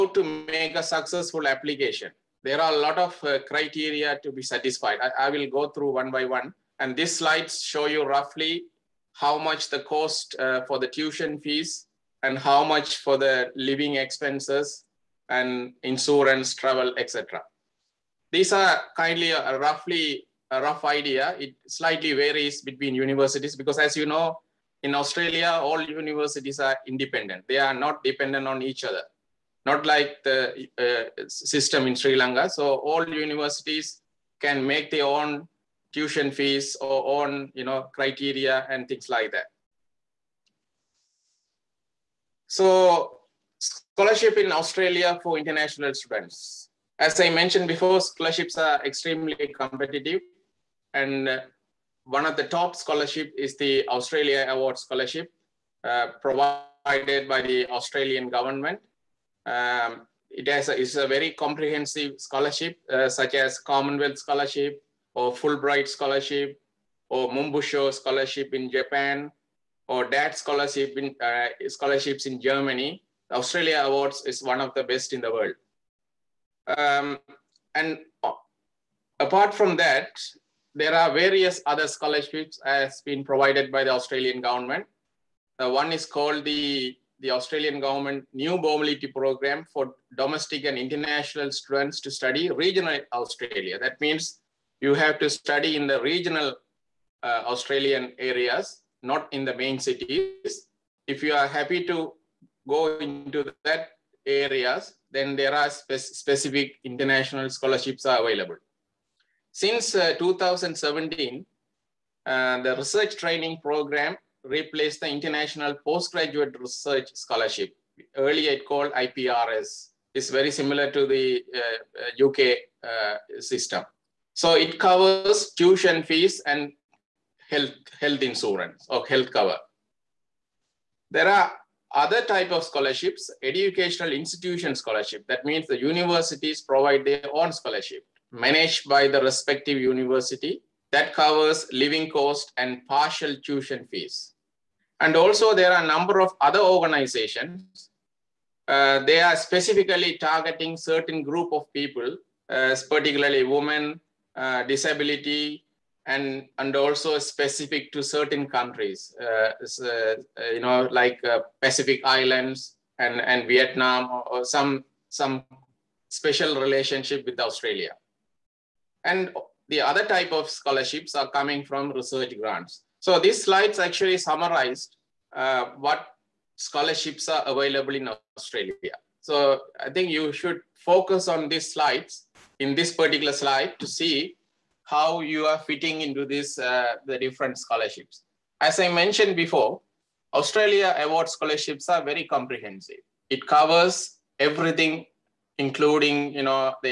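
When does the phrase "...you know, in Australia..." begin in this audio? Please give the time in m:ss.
0:23.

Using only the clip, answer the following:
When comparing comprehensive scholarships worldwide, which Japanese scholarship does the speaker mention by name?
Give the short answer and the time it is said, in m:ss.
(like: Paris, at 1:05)
Monbusho Scholarship, at 1:07.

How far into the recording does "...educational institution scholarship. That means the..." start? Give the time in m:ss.
2:13.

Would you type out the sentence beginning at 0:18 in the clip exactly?
These are kindly a, uh, a roughly a rough idea.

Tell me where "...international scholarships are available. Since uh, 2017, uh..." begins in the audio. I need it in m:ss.
1:46.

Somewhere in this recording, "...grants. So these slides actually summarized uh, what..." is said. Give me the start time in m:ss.
2:52.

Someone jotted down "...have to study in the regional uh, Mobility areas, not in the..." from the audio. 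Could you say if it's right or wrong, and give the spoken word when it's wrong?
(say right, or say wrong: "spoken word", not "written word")
wrong: "Australian", not "Mobility".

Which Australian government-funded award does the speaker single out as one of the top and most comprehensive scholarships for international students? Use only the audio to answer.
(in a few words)
Australia Award Scholarship.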